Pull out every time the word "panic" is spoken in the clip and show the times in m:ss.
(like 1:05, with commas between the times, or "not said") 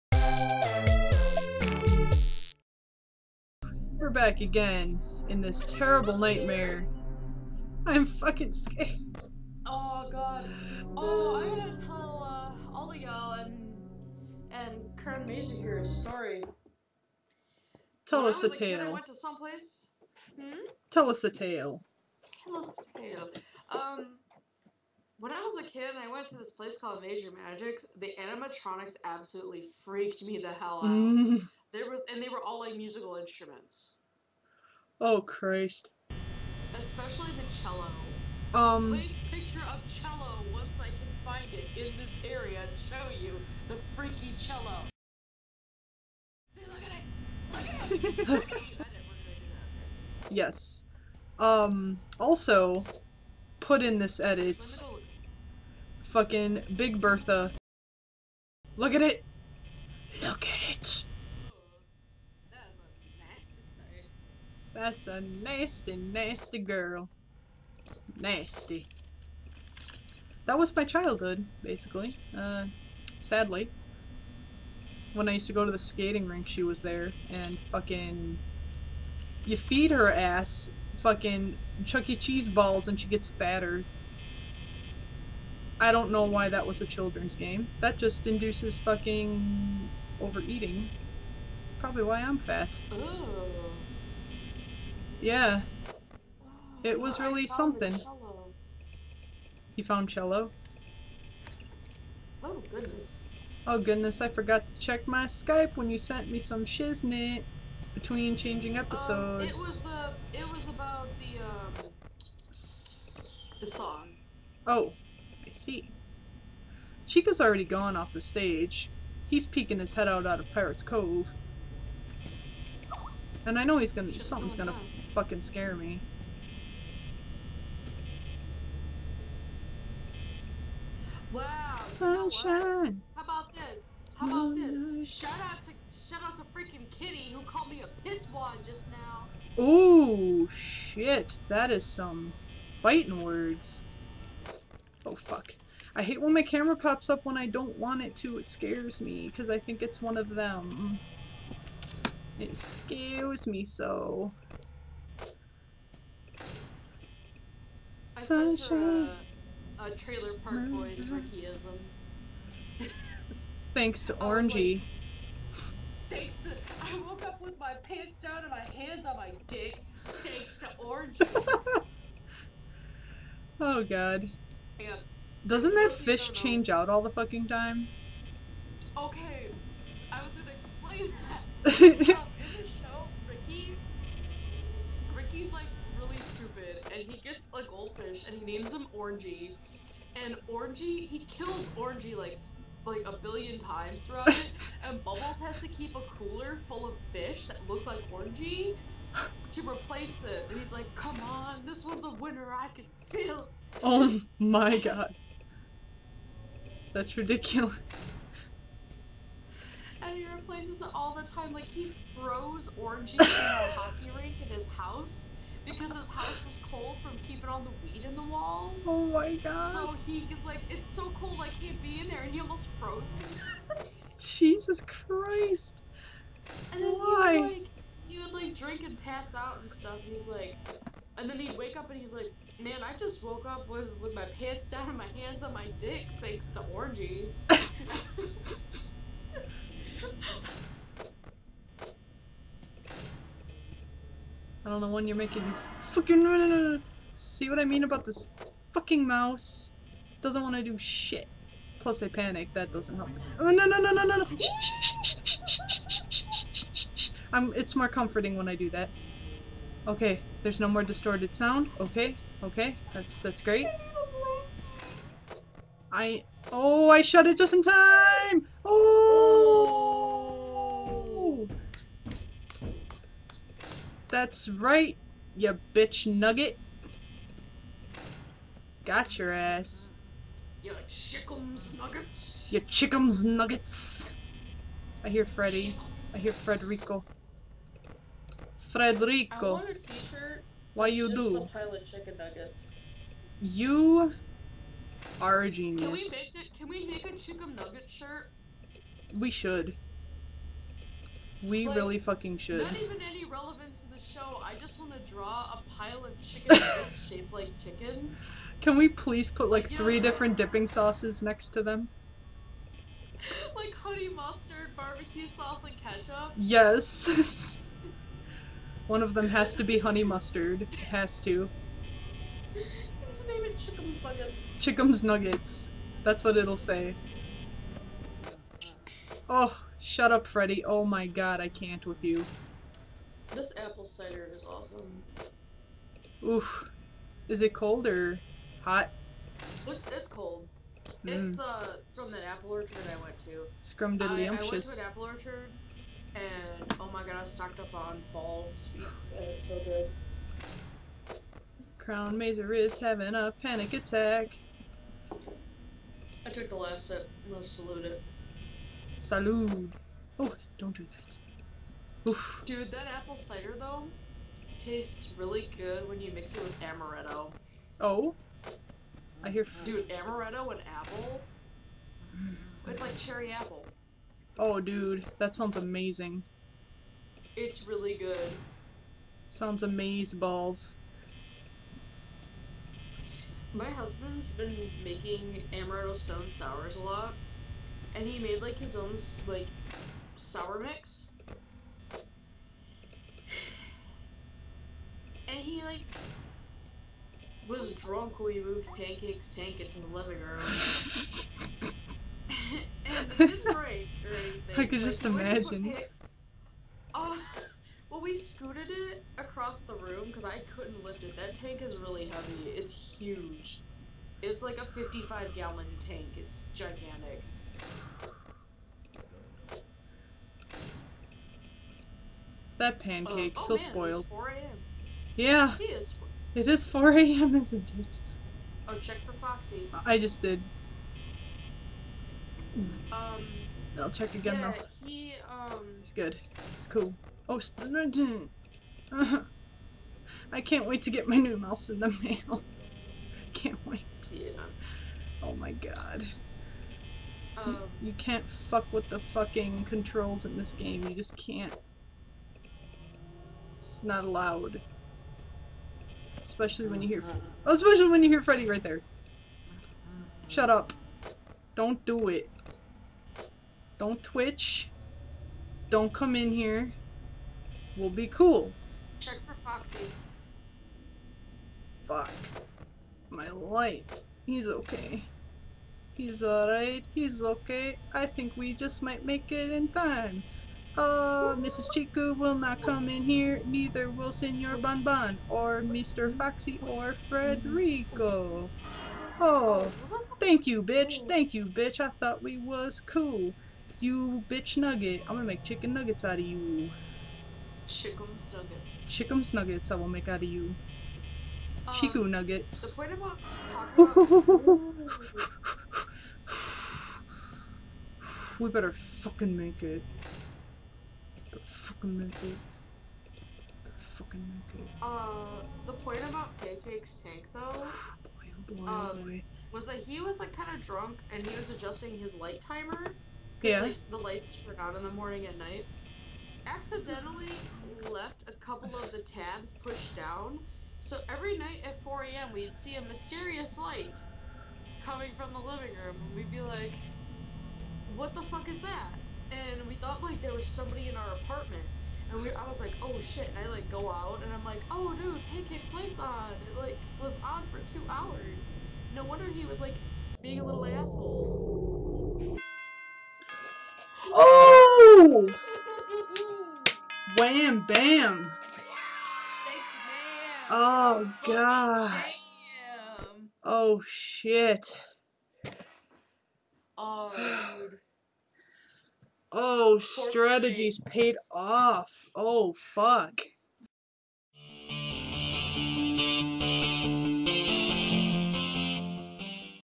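4:12, 5:53.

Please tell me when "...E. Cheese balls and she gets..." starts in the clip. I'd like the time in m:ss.
1:22.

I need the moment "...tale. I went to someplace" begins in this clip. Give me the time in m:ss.
0:18.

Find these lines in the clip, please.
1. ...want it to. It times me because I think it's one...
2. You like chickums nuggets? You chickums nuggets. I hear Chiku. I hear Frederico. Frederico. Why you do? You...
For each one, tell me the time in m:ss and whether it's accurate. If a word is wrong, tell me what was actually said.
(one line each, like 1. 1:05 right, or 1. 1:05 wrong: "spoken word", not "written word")
1. 2:27 wrong: "scares", not "times"
2. 4:40 wrong: "Freddy", not "Chiku".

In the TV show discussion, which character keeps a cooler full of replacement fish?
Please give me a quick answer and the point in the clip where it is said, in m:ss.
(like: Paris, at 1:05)
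Bubbles, at 3:15.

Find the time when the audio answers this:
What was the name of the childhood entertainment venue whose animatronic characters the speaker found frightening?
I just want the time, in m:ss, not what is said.
0:27.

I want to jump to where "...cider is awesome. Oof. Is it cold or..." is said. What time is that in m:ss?
5:33.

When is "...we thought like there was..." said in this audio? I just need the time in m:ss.
8:59.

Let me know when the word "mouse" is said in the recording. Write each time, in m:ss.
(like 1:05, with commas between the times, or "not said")
4:09, 7:21.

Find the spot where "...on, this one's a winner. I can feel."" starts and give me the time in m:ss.
3:21.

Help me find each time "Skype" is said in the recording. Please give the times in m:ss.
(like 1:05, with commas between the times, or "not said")
1:45.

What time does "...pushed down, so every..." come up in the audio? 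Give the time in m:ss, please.
8:49.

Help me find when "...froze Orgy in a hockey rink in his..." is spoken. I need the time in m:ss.
3:32.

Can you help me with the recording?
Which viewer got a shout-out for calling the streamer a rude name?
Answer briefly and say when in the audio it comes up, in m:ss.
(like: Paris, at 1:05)
Kitty, at 2:16.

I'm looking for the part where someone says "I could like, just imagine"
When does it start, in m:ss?
6:44.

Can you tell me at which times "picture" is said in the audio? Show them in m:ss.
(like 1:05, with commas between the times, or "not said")
0:39.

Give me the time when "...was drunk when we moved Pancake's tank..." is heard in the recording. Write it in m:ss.
6:37.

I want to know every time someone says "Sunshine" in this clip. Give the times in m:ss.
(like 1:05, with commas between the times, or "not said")
2:11, 2:38.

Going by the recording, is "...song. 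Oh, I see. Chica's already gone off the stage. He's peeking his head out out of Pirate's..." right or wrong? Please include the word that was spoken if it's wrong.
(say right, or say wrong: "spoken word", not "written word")
right.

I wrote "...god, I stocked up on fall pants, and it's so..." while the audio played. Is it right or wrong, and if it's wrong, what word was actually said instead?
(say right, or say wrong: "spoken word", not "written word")
wrong: "sweets", not "pants".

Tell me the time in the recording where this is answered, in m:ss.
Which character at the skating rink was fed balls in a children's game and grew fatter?
0:56.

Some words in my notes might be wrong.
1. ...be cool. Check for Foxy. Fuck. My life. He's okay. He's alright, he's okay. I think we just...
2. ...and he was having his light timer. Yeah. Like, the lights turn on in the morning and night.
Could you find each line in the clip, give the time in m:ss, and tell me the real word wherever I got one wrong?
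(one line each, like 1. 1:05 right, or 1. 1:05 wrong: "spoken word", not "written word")
1. 7:47 right
2. 8:41 wrong: "adjusting", not "having".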